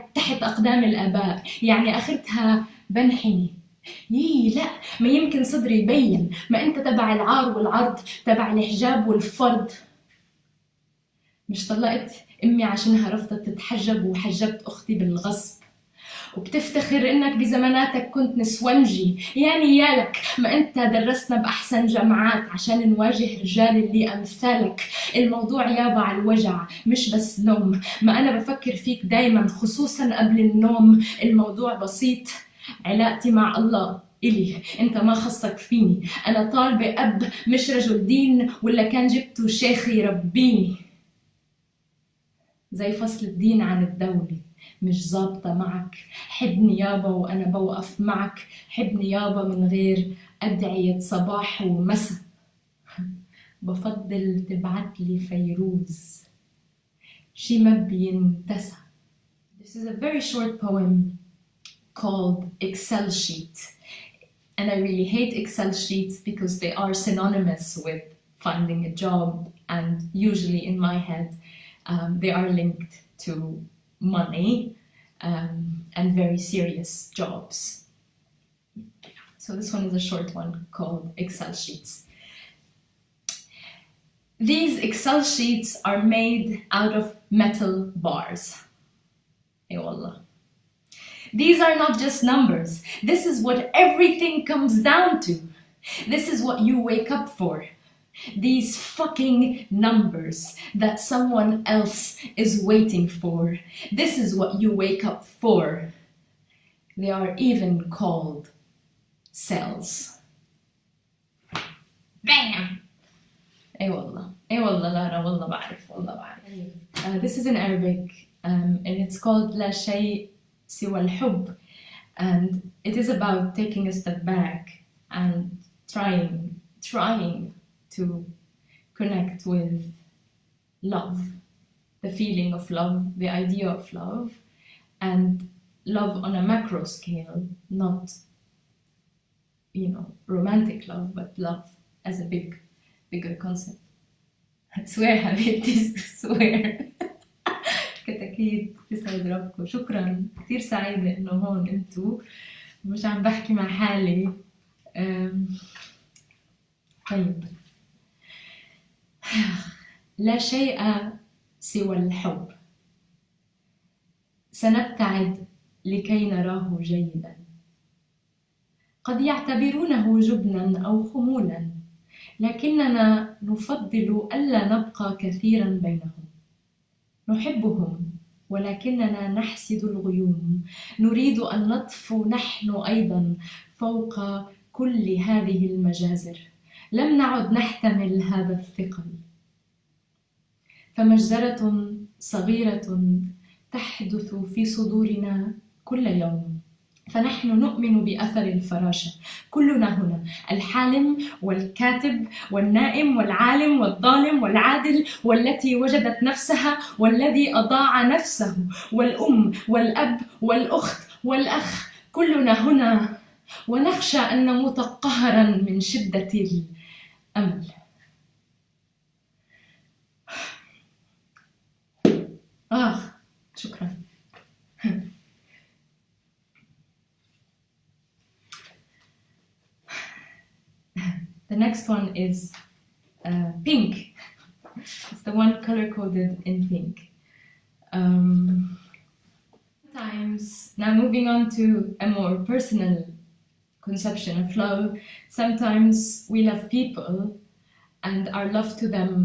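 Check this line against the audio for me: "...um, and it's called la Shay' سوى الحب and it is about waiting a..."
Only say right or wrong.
wrong.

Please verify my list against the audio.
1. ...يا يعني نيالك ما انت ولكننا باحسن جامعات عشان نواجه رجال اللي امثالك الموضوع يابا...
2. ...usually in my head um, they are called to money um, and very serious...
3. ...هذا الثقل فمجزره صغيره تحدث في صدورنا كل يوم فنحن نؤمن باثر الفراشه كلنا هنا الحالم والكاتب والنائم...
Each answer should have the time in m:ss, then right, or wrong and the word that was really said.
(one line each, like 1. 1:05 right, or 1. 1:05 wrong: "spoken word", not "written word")
1. 0:19 wrong: "درسنا", not "ولكننا"
2. 1:10 wrong: "linked", not "called"
3. 3:08 right.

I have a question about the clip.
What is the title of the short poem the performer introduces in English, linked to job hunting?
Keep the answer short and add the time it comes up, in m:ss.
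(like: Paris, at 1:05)
Excel sheet, at 1:02.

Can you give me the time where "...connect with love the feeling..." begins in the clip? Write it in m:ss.
2:08.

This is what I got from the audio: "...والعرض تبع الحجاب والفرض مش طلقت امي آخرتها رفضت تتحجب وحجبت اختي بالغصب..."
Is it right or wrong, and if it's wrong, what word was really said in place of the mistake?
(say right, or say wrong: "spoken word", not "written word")
wrong: "عشانها", not "آخرتها".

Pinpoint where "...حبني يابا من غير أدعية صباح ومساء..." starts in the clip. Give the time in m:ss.
0:48.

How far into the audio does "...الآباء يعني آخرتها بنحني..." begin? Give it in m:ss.
0:00.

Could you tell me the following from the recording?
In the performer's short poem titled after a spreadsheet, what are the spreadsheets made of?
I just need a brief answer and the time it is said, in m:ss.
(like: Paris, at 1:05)
metal bars, at 1:27.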